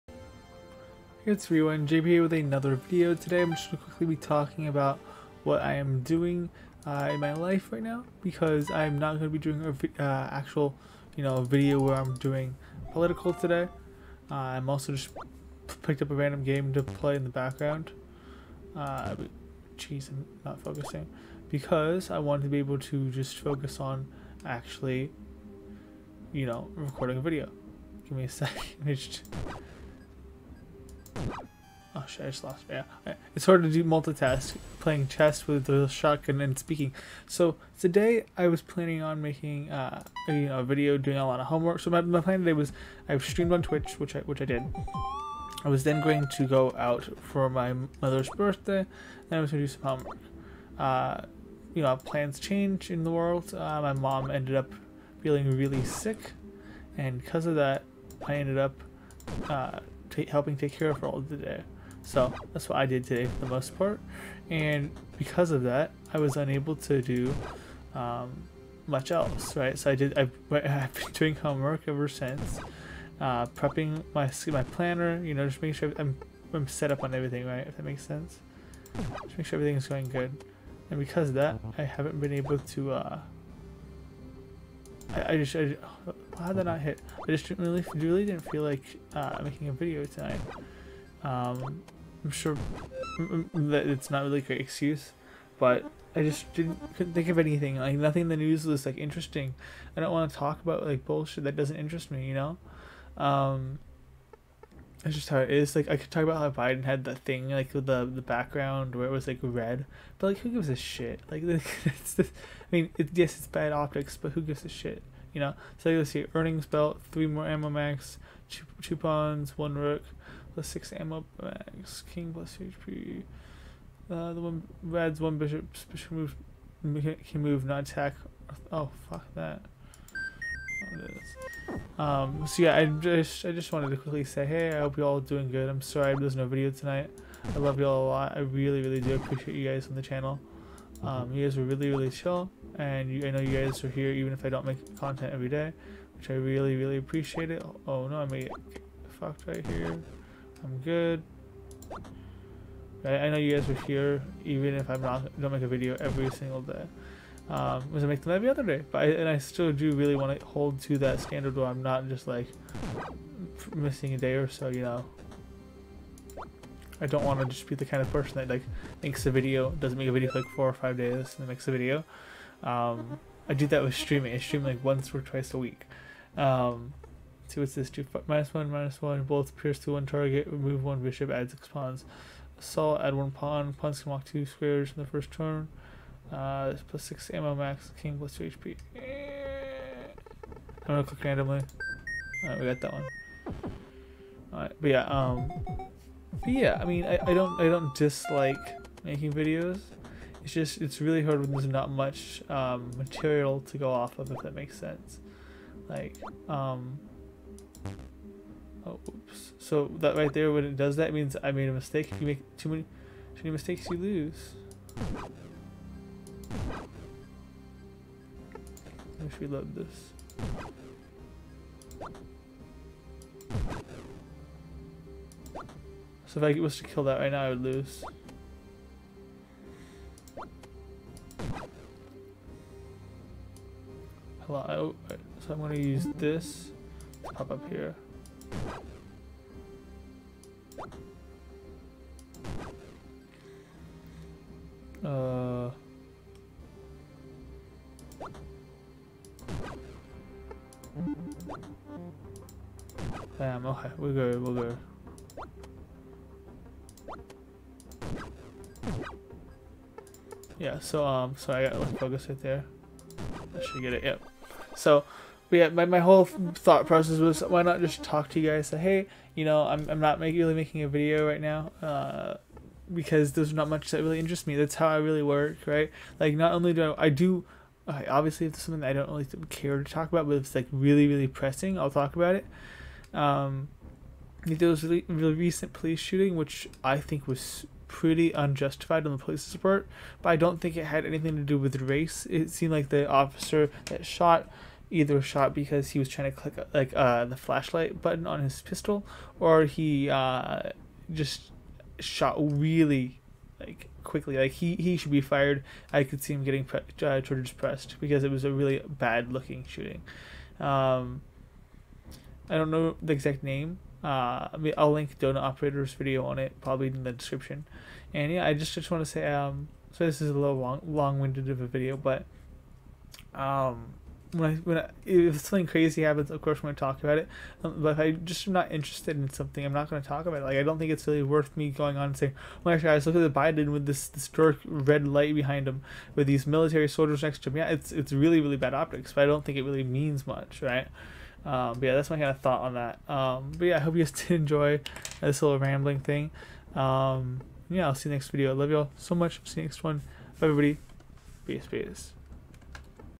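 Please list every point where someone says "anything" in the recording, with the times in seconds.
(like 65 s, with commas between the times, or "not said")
97 s, 291 s.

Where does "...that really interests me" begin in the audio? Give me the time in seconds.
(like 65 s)
273 s.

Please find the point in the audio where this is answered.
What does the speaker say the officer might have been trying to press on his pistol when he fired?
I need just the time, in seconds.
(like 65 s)
297 s.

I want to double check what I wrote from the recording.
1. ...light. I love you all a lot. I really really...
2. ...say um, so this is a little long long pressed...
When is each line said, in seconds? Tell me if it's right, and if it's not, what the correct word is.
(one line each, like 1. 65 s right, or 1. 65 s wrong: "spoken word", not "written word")
1. 136 s wrong: "tonight", not "light"
2. 319 s wrong: "winded", not "pressed".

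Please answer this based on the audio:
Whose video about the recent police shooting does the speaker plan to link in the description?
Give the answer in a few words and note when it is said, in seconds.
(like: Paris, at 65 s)
Donut Operator, at 315 s.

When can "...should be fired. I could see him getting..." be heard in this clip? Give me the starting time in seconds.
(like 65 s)
304 s.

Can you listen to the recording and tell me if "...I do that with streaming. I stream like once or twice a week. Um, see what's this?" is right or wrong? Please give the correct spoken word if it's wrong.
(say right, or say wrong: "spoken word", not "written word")
right.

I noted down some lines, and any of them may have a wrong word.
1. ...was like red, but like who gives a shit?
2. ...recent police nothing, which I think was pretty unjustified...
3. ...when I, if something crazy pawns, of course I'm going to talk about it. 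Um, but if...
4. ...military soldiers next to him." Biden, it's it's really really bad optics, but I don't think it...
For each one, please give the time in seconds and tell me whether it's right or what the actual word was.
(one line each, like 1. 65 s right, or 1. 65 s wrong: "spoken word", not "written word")
1. 109 s right
2. 285 s wrong: "shooting", not "nothing"
3. 324 s wrong: "happens", not "pawns"
4. 336 s wrong: "Yeah", not "Biden".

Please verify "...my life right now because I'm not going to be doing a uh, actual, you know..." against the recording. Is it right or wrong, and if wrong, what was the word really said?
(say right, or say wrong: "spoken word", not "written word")
right.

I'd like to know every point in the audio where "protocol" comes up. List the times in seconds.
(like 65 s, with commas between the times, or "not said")
not said.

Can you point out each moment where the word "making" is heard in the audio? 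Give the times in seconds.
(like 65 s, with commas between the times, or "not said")
39 s, 75 s, 89 s, 199 s, 270 s.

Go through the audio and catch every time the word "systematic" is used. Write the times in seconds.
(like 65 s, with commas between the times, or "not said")
not said.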